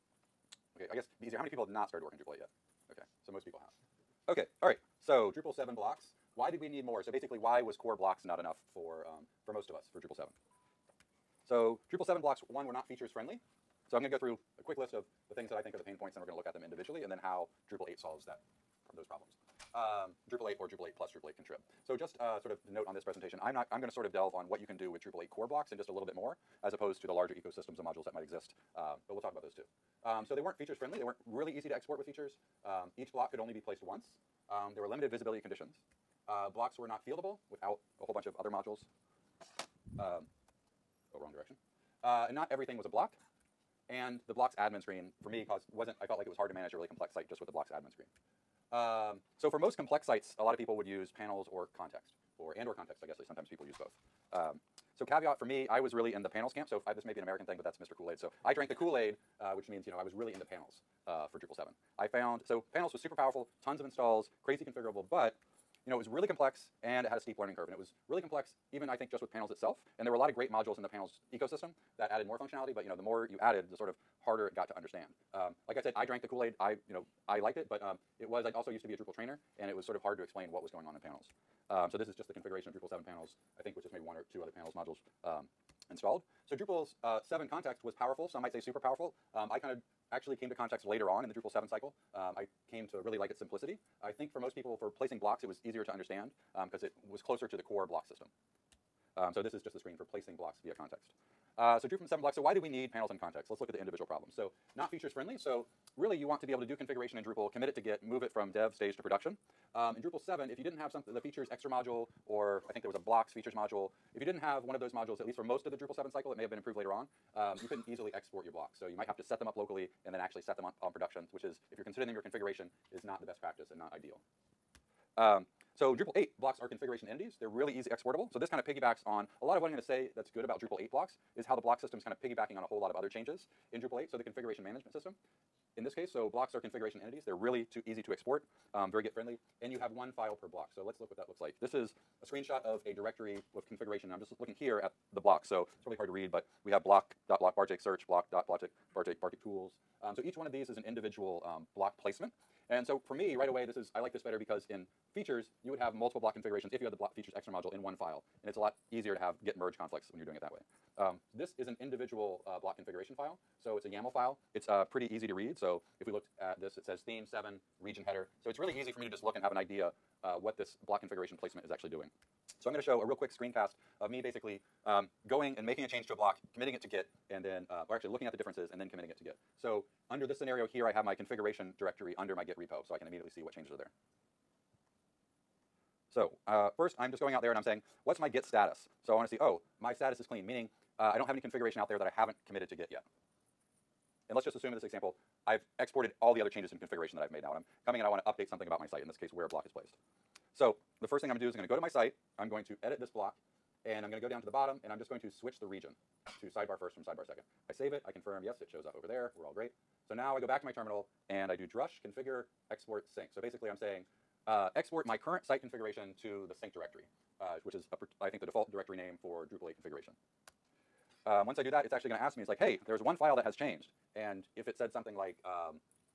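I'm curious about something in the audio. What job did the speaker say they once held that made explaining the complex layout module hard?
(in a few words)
Drupal trainer.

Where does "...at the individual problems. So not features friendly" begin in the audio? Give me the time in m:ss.
1:43.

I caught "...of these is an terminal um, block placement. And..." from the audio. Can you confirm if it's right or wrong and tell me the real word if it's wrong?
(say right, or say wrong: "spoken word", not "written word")
wrong: "individual", not "terminal".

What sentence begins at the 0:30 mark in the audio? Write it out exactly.
Um, so they weren't features friendly.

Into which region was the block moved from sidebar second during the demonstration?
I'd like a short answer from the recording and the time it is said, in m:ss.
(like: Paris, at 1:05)
Sidebar first, at 3:26.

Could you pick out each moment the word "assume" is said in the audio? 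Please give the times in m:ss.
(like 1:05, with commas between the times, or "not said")
3:14.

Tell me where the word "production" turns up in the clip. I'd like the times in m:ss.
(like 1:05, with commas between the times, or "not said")
1:49, 2:00.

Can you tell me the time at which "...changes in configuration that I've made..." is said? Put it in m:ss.
3:16.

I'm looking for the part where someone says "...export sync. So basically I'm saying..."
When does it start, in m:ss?
3:32.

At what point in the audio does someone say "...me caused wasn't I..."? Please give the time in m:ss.
0:45.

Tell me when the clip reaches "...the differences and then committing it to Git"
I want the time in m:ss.
2:58.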